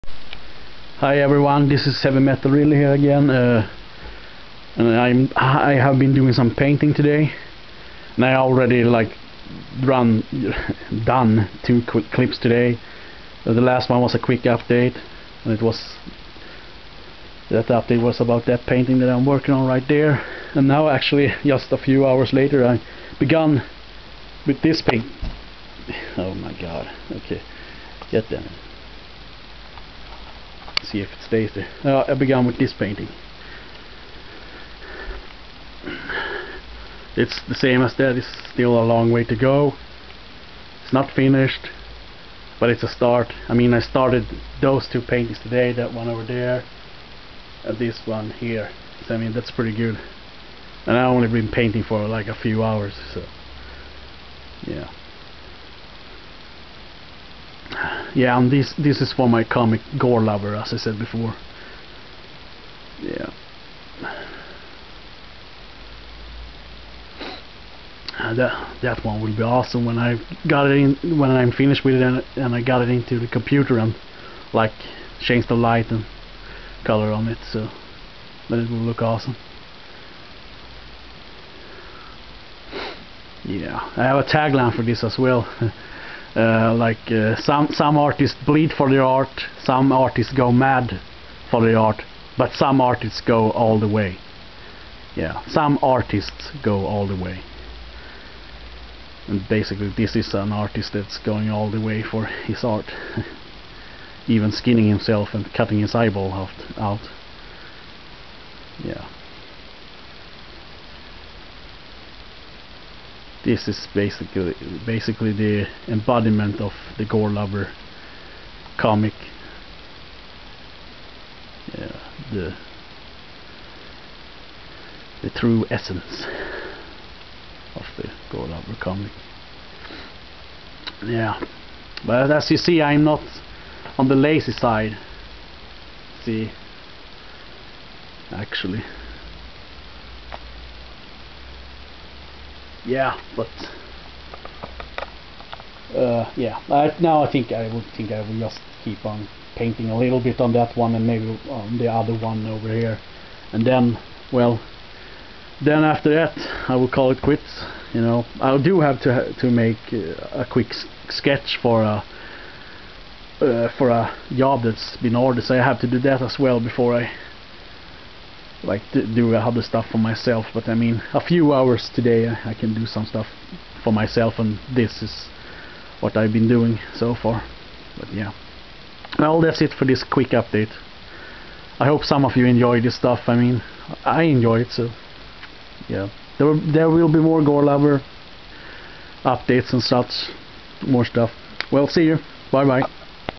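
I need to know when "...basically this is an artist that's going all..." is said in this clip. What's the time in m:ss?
1:39.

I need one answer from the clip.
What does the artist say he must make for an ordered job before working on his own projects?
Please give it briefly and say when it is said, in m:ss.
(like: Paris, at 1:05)
a quick sketch, at 2:40.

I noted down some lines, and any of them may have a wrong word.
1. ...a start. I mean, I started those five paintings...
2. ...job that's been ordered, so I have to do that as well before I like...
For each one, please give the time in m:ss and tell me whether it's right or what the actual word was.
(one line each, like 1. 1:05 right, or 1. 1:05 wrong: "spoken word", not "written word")
1. 0:42 wrong: "two", not "five"
2. 2:44 right.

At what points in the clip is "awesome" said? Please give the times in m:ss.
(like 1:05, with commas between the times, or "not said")
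1:09, 1:19.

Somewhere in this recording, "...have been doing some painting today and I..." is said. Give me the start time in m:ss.
0:05.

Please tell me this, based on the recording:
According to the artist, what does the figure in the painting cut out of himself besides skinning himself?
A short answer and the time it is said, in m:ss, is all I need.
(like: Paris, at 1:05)
his eyeball, at 1:45.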